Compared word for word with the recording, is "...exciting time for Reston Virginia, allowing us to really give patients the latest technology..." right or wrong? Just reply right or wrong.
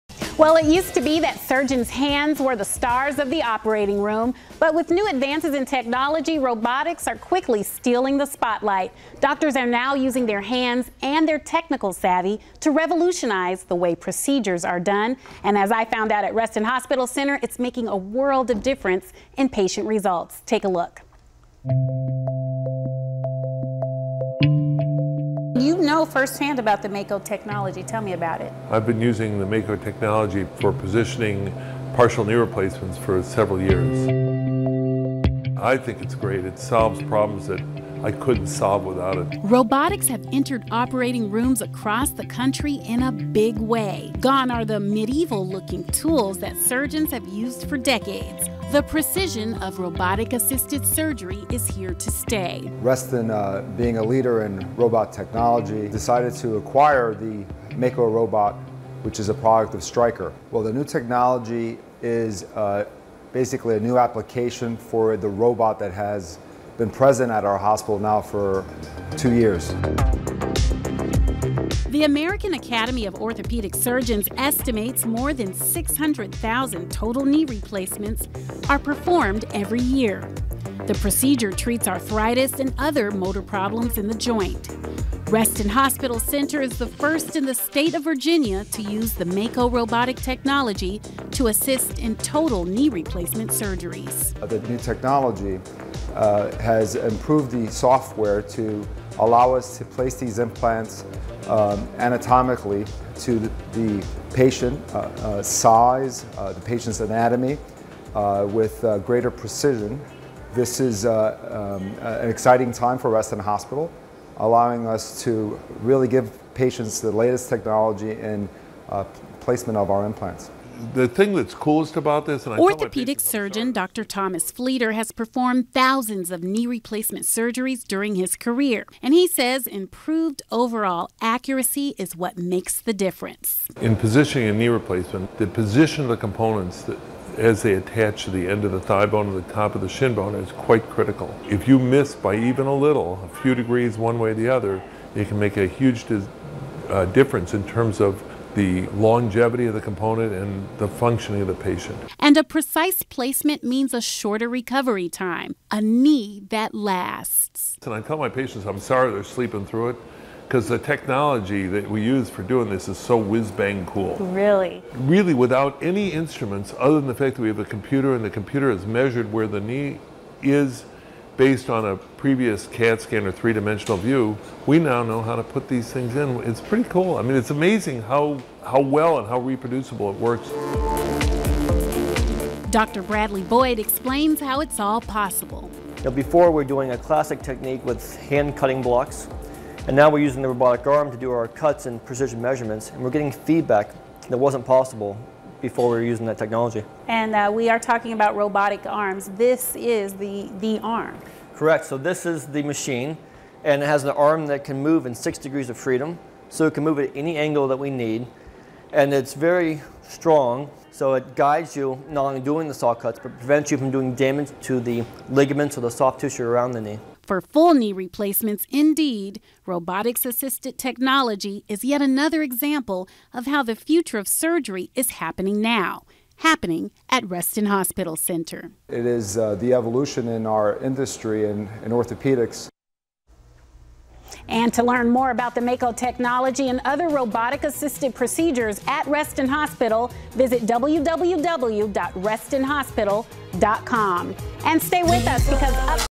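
wrong.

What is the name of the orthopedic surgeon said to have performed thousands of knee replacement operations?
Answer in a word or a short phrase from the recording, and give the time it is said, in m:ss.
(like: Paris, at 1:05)
Dr. Thomas Fleeter, at 2:03.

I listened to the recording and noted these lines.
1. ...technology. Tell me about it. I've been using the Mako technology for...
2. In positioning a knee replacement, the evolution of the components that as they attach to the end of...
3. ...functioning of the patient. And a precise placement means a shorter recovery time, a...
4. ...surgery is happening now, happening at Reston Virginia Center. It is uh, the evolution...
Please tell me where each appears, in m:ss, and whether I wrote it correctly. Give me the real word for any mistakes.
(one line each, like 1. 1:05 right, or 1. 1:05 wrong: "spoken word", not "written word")
1. 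0:27 right
2. 2:13 wrong: "position", not "evolution"
3. 2:30 right
4. 3:44 wrong: "Hospital", not "Virginia".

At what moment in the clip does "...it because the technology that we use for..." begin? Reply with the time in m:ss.
2:39.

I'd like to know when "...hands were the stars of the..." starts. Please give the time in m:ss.
0:01.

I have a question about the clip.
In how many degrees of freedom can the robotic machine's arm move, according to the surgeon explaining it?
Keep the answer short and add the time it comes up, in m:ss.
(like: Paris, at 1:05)
6, at 3:25.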